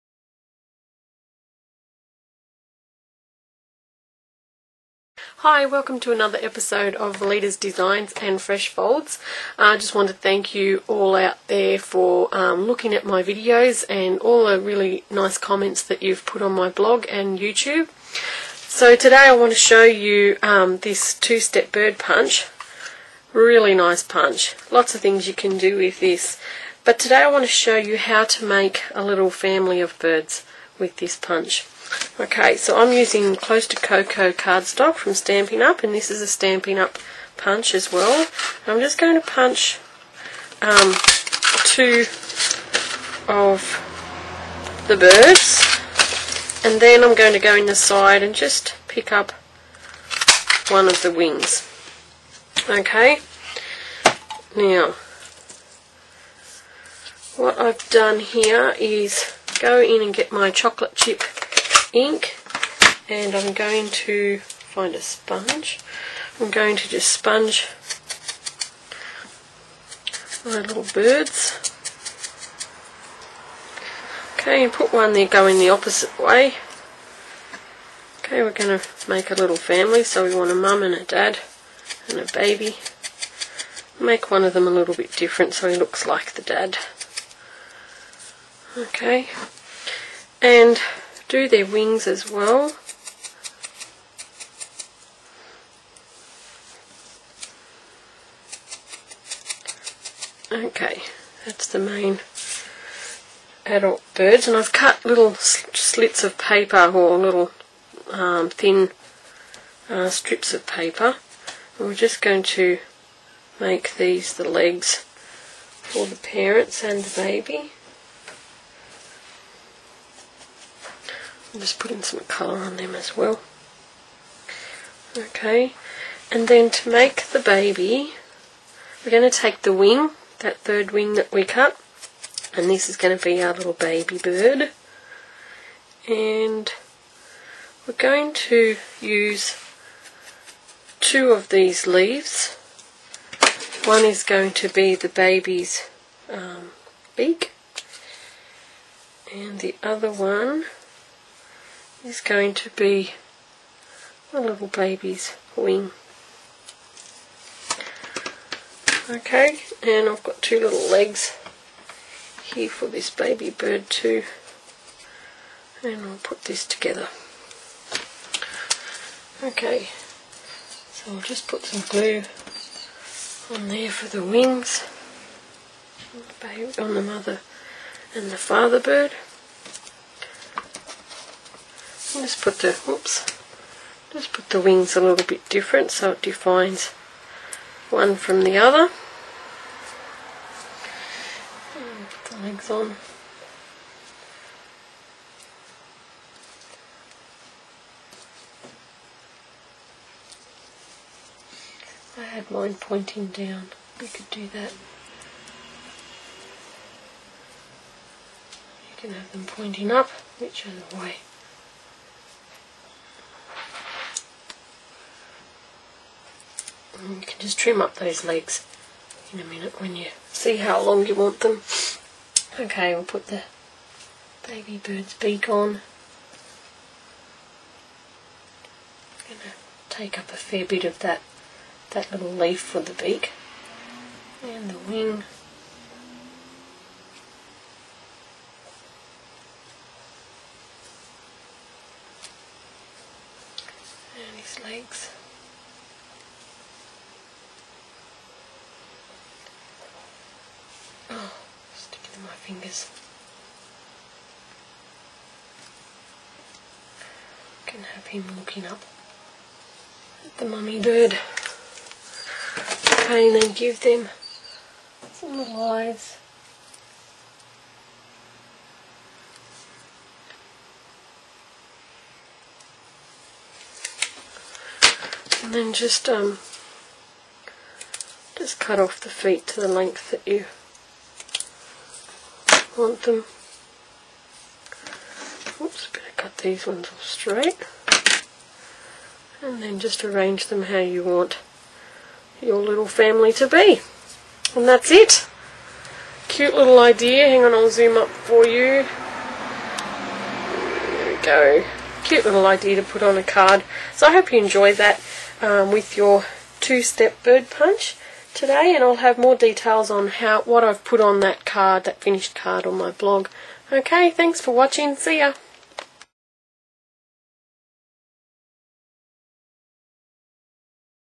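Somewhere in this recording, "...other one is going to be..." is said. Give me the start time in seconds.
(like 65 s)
149 s.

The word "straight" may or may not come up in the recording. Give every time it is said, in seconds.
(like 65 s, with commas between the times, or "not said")
287 s.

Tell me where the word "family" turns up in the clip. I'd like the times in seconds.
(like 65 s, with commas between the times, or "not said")
29 s, 79 s, 292 s.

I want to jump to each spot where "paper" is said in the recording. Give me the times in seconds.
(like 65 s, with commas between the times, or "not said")
106 s, 110 s.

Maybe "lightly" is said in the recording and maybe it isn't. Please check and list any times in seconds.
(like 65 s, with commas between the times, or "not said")
not said.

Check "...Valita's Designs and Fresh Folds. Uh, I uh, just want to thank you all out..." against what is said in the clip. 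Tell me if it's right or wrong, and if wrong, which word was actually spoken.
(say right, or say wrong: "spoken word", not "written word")
right.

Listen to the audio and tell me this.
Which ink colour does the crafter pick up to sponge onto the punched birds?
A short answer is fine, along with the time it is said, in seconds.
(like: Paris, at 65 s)
chocolate chip, at 60 s.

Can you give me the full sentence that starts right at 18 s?
So today I want to show you um, this two-step bird punch.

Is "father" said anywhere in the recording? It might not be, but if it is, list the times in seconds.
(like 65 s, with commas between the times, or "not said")
178 s.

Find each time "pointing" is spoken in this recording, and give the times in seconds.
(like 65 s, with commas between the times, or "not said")
202 s, 209 s.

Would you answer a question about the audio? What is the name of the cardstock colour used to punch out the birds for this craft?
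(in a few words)
Close to Cocoa.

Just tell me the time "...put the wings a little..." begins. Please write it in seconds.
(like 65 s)
184 s.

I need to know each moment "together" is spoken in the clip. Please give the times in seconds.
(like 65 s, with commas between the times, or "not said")
166 s.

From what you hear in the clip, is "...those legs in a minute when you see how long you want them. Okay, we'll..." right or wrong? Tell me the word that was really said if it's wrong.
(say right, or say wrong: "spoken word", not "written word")
right.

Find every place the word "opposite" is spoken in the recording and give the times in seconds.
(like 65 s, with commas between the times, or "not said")
75 s.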